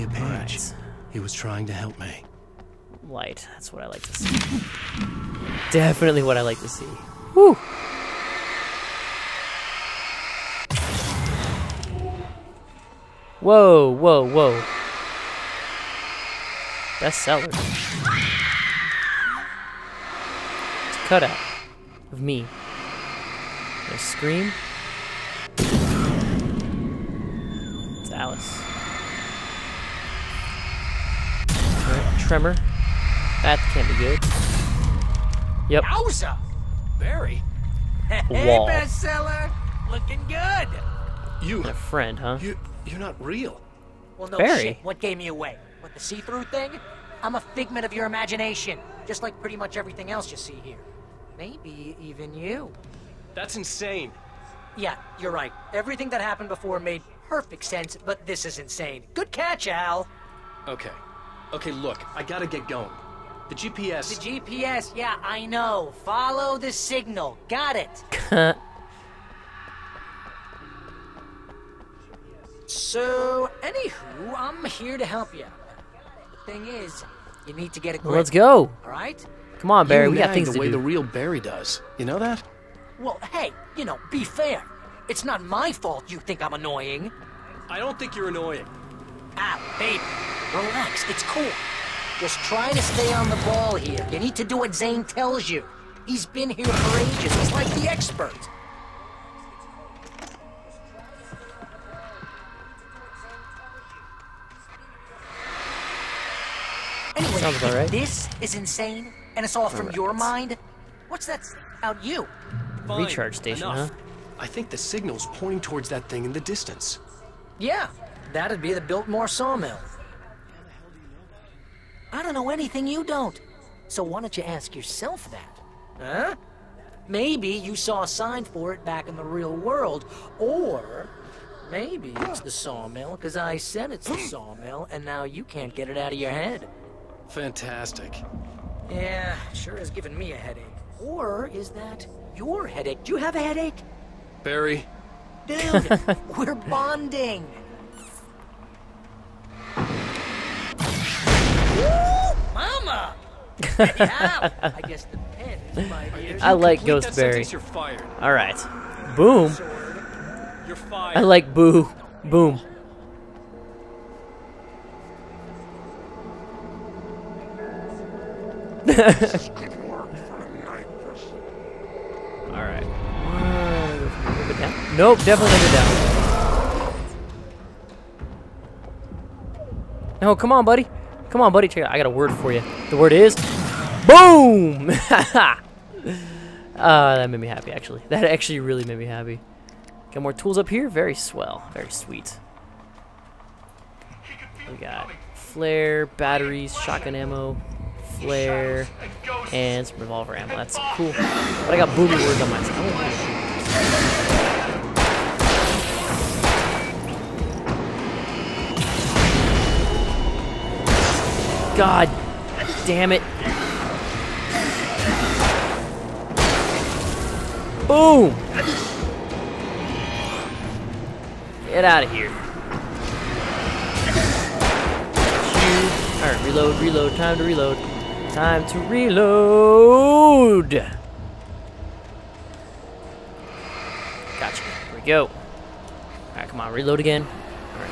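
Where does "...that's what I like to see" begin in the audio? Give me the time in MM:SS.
00:03.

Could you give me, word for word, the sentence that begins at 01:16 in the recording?
Thing is, you need to get a grip.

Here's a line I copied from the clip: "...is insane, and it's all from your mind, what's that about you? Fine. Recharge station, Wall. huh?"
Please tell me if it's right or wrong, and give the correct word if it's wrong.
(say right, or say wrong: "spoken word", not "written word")
wrong: "Enough", not "Wall".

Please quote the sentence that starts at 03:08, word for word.
That actually really made me happy.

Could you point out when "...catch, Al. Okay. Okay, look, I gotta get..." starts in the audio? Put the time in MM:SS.
00:59.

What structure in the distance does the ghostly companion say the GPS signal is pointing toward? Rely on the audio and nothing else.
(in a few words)
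Biltmore sawmill.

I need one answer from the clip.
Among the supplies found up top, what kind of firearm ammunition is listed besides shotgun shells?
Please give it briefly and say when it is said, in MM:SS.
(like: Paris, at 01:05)
revolver ammo, at 03:19.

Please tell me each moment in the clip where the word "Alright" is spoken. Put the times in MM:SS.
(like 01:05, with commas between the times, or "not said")
02:52, 03:46, 03:56.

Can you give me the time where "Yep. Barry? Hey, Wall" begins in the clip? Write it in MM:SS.
00:35.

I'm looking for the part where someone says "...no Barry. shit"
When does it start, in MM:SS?
00:44.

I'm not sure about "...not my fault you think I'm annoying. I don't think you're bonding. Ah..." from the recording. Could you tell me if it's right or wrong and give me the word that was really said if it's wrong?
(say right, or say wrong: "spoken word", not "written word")
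wrong: "annoying", not "bonding".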